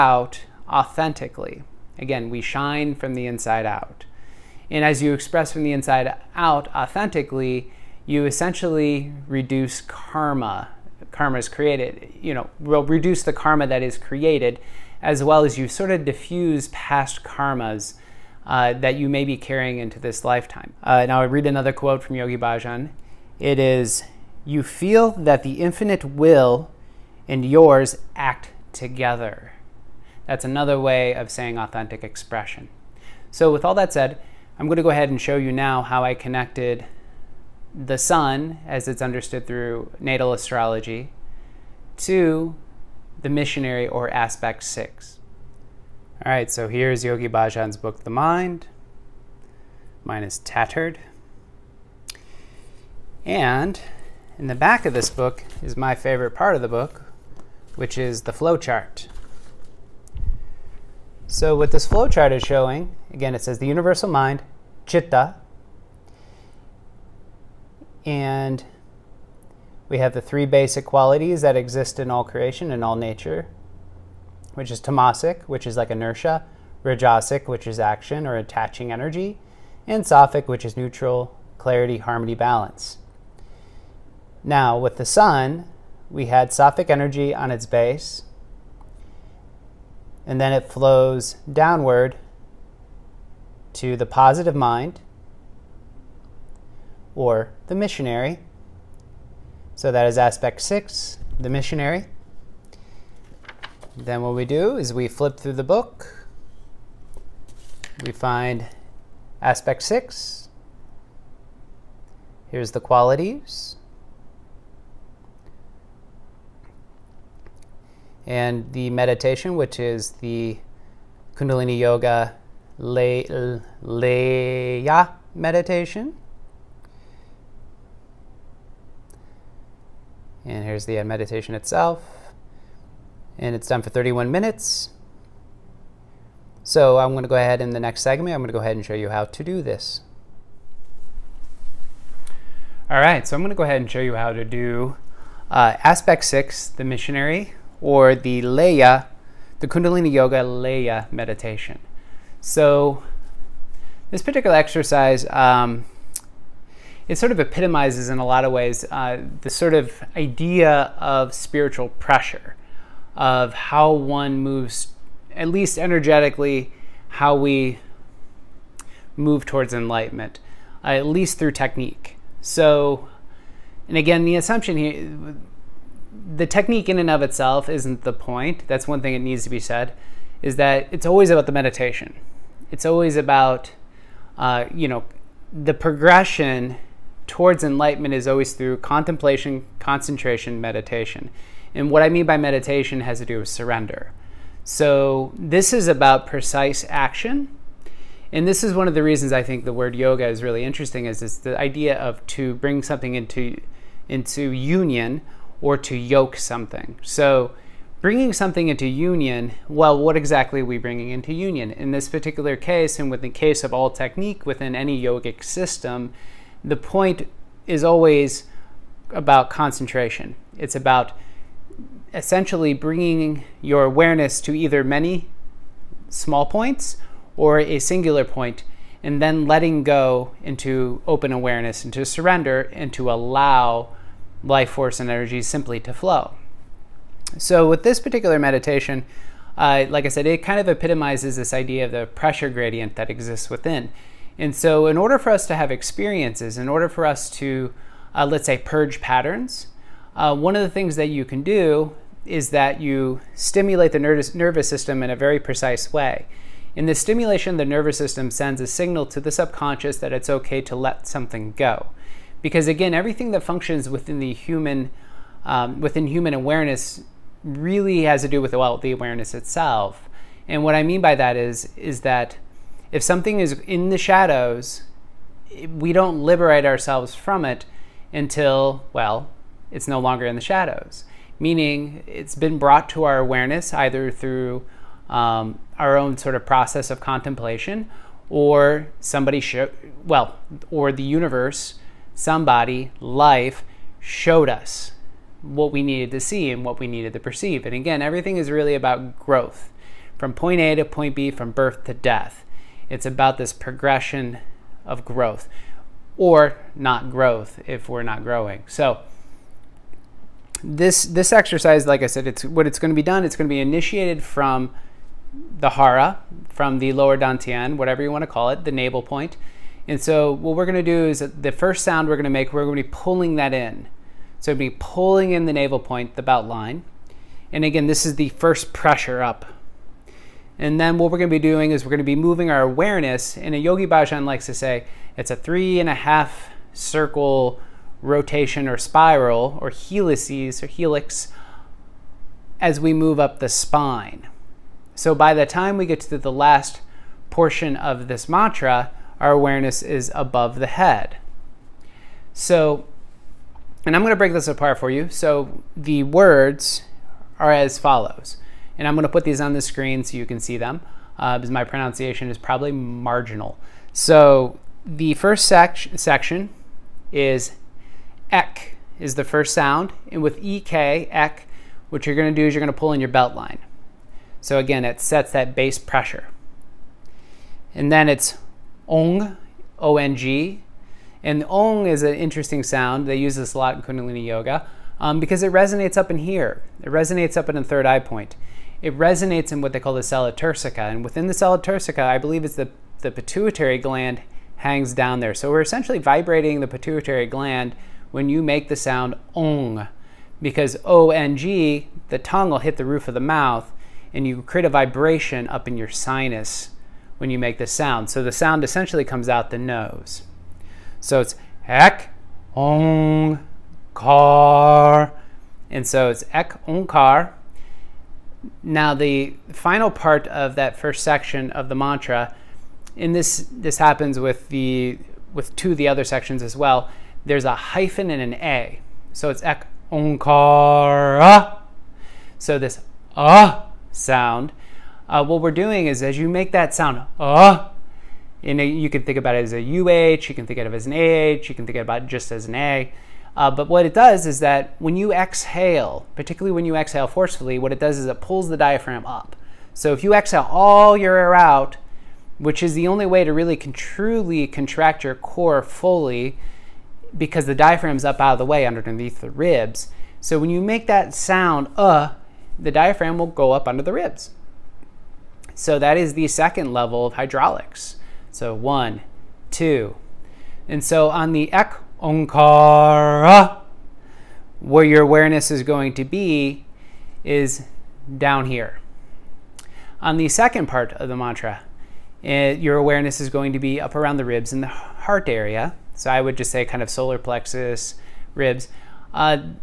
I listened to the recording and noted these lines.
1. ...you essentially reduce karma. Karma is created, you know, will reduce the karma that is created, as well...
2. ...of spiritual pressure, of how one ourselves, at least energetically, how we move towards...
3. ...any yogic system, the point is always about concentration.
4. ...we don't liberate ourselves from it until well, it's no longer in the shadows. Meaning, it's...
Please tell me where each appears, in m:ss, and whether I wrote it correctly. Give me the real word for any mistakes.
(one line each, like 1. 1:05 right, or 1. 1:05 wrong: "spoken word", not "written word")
1. 0:08 right
2. 2:40 wrong: "moves", not "ourselves"
3. 3:34 right
4. 4:35 right.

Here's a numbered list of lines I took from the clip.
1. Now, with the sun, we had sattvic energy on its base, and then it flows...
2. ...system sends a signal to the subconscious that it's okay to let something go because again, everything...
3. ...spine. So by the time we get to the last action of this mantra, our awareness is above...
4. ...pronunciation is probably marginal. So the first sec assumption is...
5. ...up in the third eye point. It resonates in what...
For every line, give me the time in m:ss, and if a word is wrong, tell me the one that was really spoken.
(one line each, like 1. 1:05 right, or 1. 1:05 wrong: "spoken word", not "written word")
1. 1:24 right
2. 4:17 right
3. 5:43 wrong: "portion", not "action"
4. 6:01 wrong: "section", not "assumption"
5. 6:27 right.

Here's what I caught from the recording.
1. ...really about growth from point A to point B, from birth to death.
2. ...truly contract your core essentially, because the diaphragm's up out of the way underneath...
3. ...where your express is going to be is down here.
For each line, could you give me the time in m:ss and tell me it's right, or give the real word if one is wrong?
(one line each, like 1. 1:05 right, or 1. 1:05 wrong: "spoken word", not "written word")
1. 4:58 right
2. 7:33 wrong: "fully", not "essentially"
3. 7:54 wrong: "awareness", not "express".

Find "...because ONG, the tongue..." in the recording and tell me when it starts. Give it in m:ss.
6:40.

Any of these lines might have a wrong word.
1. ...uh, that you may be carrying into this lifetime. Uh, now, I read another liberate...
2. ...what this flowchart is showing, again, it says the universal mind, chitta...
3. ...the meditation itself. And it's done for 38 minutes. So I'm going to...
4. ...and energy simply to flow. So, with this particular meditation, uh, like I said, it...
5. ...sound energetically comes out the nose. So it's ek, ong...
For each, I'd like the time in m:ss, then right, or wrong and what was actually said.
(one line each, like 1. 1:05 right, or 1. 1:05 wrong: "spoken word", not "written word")
1. 0:18 wrong: "quote", not "liberate"
2. 1:01 right
3. 2:10 wrong: "31", not "38"
4. 3:54 right
5. 6:48 wrong: "essentially", not "energetically".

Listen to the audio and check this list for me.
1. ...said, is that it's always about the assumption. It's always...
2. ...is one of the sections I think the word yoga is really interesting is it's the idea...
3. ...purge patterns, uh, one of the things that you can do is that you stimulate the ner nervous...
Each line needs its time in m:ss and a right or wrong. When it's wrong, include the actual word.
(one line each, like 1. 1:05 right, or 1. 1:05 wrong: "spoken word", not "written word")
1. 2:59 wrong: "meditation", not "assumption"
2. 3:18 wrong: "reasons", not "sections"
3. 4:08 right.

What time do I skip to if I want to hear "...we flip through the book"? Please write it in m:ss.
1:44.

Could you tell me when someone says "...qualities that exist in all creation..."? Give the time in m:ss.
1:10.